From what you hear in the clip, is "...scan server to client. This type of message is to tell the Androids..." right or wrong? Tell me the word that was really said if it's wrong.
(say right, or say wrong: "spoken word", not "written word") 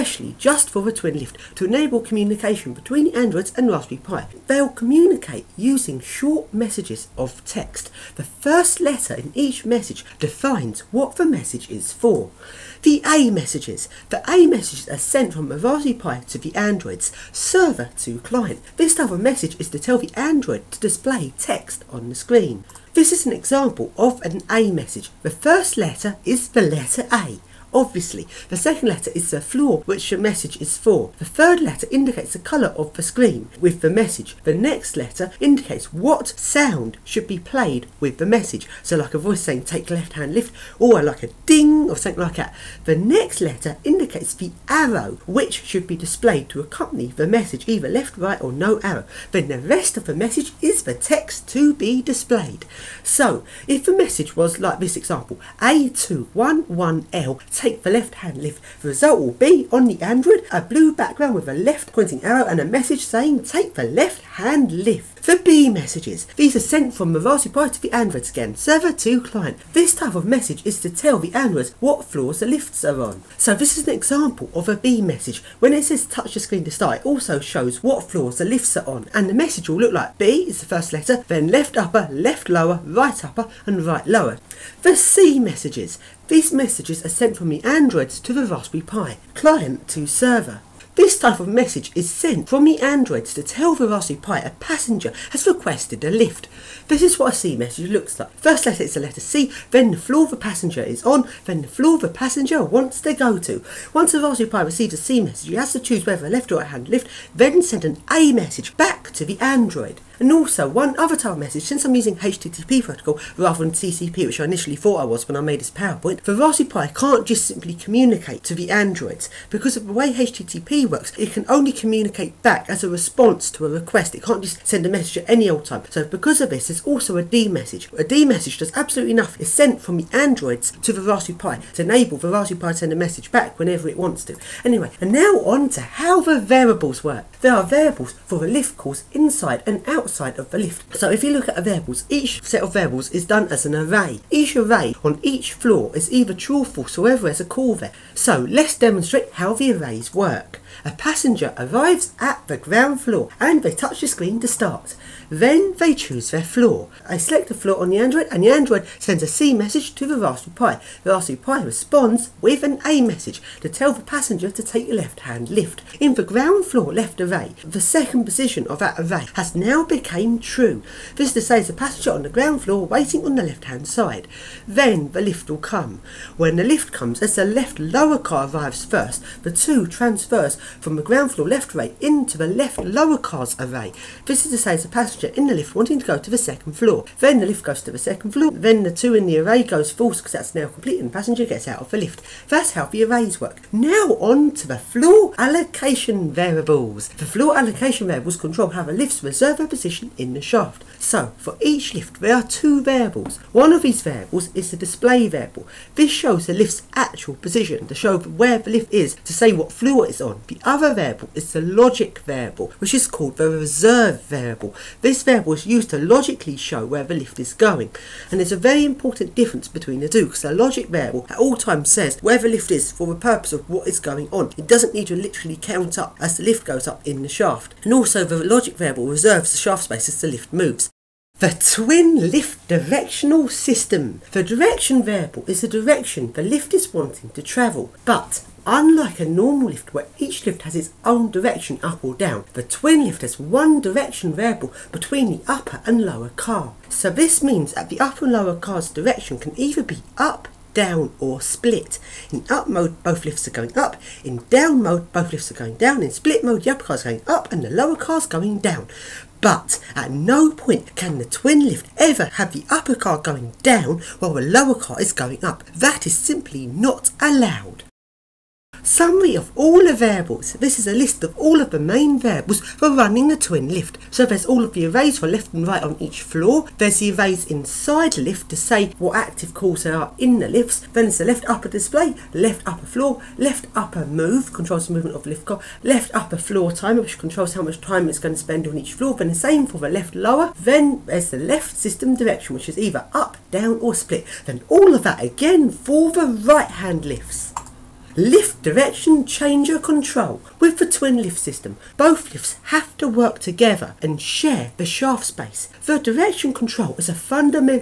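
right.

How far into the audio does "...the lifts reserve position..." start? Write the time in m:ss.
3:18.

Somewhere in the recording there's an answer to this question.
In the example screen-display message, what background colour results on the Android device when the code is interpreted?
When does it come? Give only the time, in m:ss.
1:00.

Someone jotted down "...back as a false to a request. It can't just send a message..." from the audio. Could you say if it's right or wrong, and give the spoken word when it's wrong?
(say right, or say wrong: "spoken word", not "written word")
wrong: "response", not "false".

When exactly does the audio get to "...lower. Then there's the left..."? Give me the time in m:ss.
4:50.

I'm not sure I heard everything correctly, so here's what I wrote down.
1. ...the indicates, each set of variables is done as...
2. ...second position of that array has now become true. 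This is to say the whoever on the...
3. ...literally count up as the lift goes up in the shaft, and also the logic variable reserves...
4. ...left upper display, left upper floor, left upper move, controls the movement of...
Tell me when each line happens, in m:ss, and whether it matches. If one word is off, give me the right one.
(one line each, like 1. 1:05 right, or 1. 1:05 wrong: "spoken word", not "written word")
1. 2:21 wrong: "variables", not "indicates"
2. 2:47 wrong: "passenger", not "whoever"
3. 3:45 right
4. 4:41 right.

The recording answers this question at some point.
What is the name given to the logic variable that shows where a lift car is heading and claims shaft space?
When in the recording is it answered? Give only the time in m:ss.
3:33.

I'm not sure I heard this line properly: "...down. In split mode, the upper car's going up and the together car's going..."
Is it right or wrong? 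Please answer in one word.
wrong.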